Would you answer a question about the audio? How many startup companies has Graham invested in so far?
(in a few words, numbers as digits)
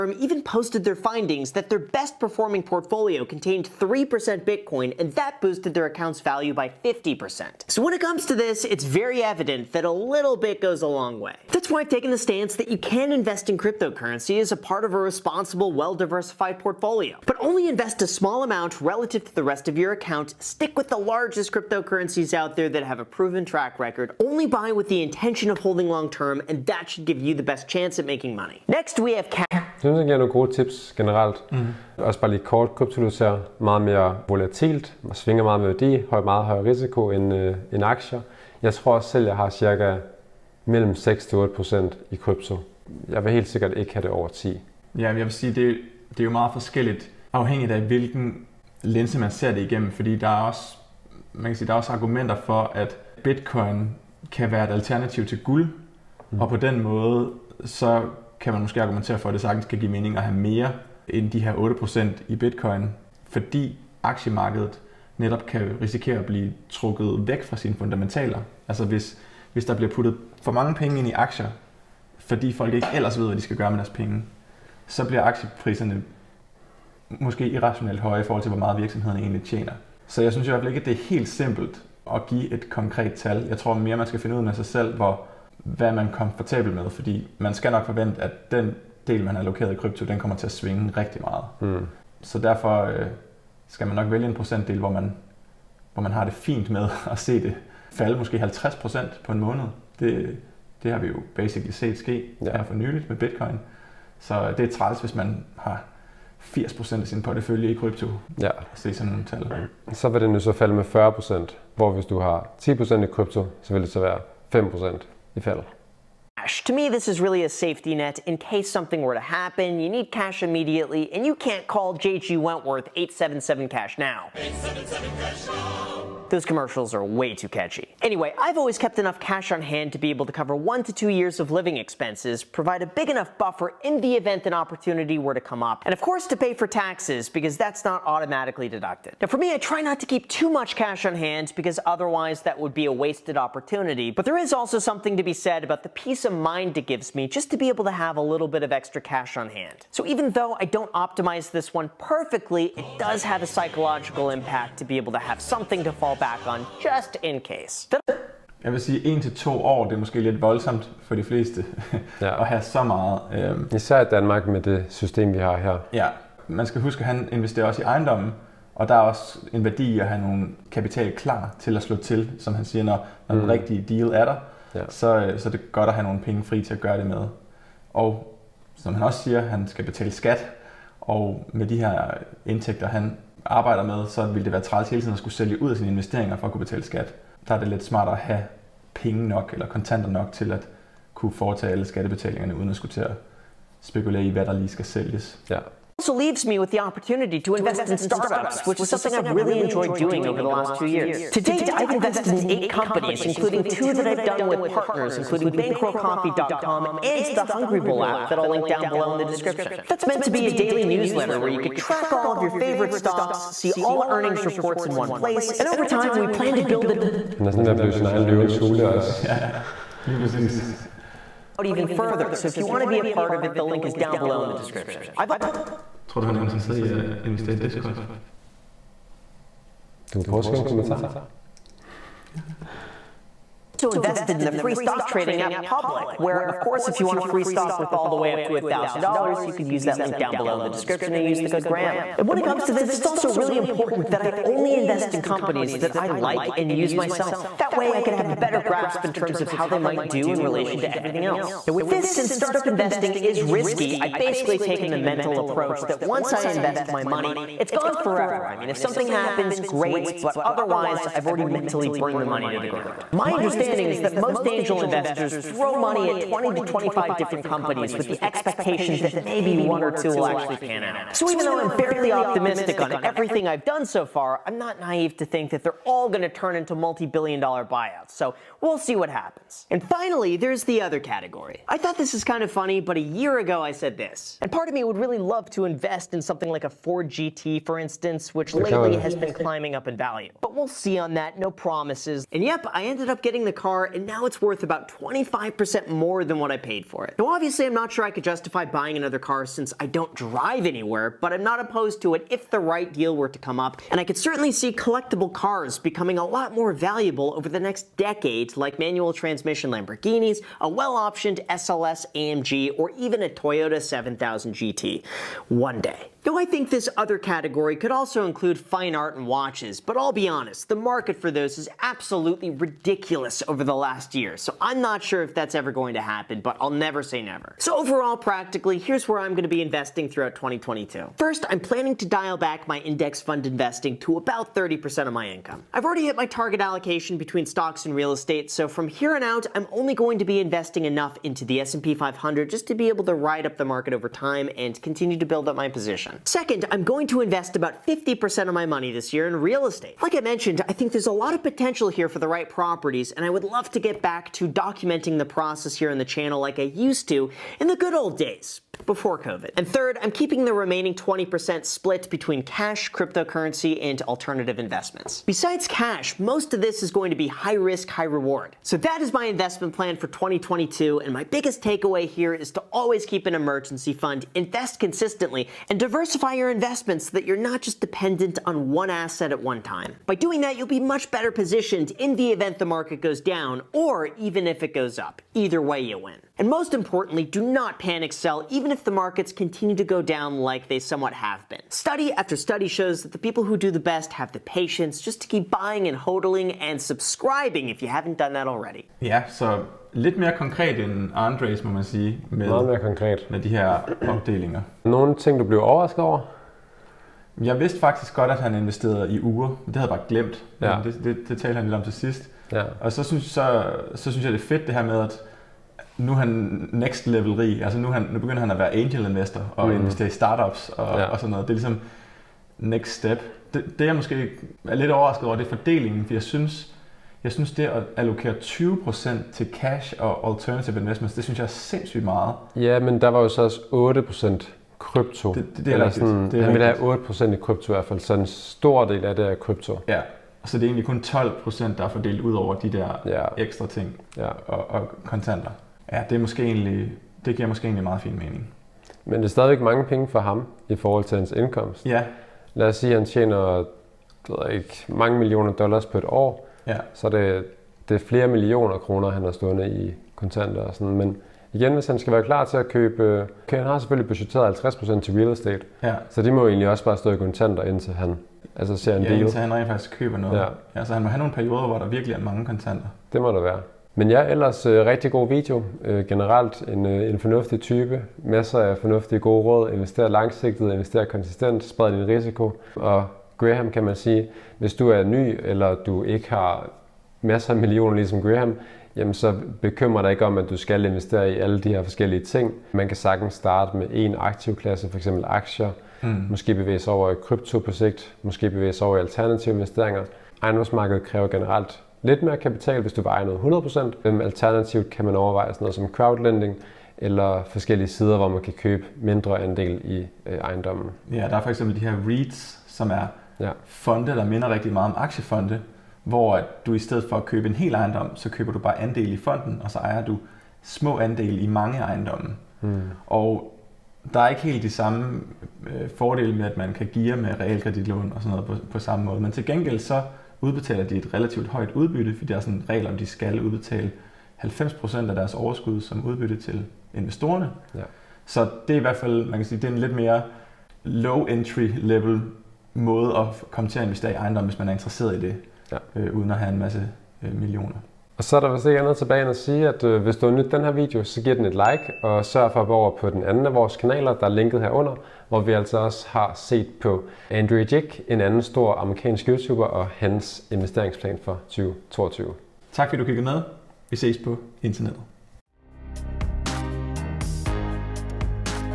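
8.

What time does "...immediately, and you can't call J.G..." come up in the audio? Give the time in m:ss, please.
2:00.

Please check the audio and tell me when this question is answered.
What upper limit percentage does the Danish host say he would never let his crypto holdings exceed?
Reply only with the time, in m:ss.
0:44.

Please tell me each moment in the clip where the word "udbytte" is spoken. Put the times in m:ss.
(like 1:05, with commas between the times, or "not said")
8:51, 8:56.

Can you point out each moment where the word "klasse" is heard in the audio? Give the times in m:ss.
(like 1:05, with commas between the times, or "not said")
8:14.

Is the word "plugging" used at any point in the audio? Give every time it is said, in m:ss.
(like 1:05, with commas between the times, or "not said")
not said.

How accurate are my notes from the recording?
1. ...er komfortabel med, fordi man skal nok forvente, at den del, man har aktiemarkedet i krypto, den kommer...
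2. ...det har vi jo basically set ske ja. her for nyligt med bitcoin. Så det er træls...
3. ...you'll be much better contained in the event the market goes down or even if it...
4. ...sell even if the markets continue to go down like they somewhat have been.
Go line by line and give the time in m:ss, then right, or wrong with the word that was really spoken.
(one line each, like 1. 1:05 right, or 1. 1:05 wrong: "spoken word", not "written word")
1. 1:26 wrong: "allokeret", not "aktiemarkedet"
2. 1:40 right
3. 6:20 wrong: "positioned", not "contained"
4. 6:28 right.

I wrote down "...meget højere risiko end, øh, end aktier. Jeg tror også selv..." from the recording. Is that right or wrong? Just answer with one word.
right.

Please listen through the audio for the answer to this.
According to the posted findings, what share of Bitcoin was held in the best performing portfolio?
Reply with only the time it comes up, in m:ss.
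0:03.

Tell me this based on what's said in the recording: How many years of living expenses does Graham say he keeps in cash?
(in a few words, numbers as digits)
1 to 2 years.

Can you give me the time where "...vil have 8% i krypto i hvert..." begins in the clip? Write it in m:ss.
7:16.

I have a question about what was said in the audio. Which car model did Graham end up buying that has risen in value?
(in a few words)
Ford GT.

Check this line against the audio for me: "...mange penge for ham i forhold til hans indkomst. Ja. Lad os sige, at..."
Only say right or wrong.
right.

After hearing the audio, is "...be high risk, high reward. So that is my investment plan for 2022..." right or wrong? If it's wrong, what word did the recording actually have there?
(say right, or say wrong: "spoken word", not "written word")
right.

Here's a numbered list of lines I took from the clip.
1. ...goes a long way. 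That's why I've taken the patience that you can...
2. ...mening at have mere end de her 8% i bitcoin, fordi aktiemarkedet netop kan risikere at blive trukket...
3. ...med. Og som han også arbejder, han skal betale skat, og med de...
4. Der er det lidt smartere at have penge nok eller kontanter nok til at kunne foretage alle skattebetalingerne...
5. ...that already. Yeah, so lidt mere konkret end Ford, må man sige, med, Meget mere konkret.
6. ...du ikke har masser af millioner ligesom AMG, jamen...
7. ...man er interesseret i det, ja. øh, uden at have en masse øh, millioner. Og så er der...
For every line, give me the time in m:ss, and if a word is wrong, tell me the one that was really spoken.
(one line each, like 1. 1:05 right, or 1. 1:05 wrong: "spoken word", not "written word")
1. 0:10 wrong: "stance", not "patience"
2. 0:59 right
3. 2:57 wrong: "siger", not "arbejder"
4. 3:07 right
5. 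6:38 wrong: "Andres", not "Ford"
6. 8:05 wrong: "Graham", not "AMG"
7. 9:04 right.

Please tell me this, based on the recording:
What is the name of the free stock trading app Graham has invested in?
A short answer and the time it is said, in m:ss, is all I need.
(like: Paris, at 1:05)
Public, at 3:55.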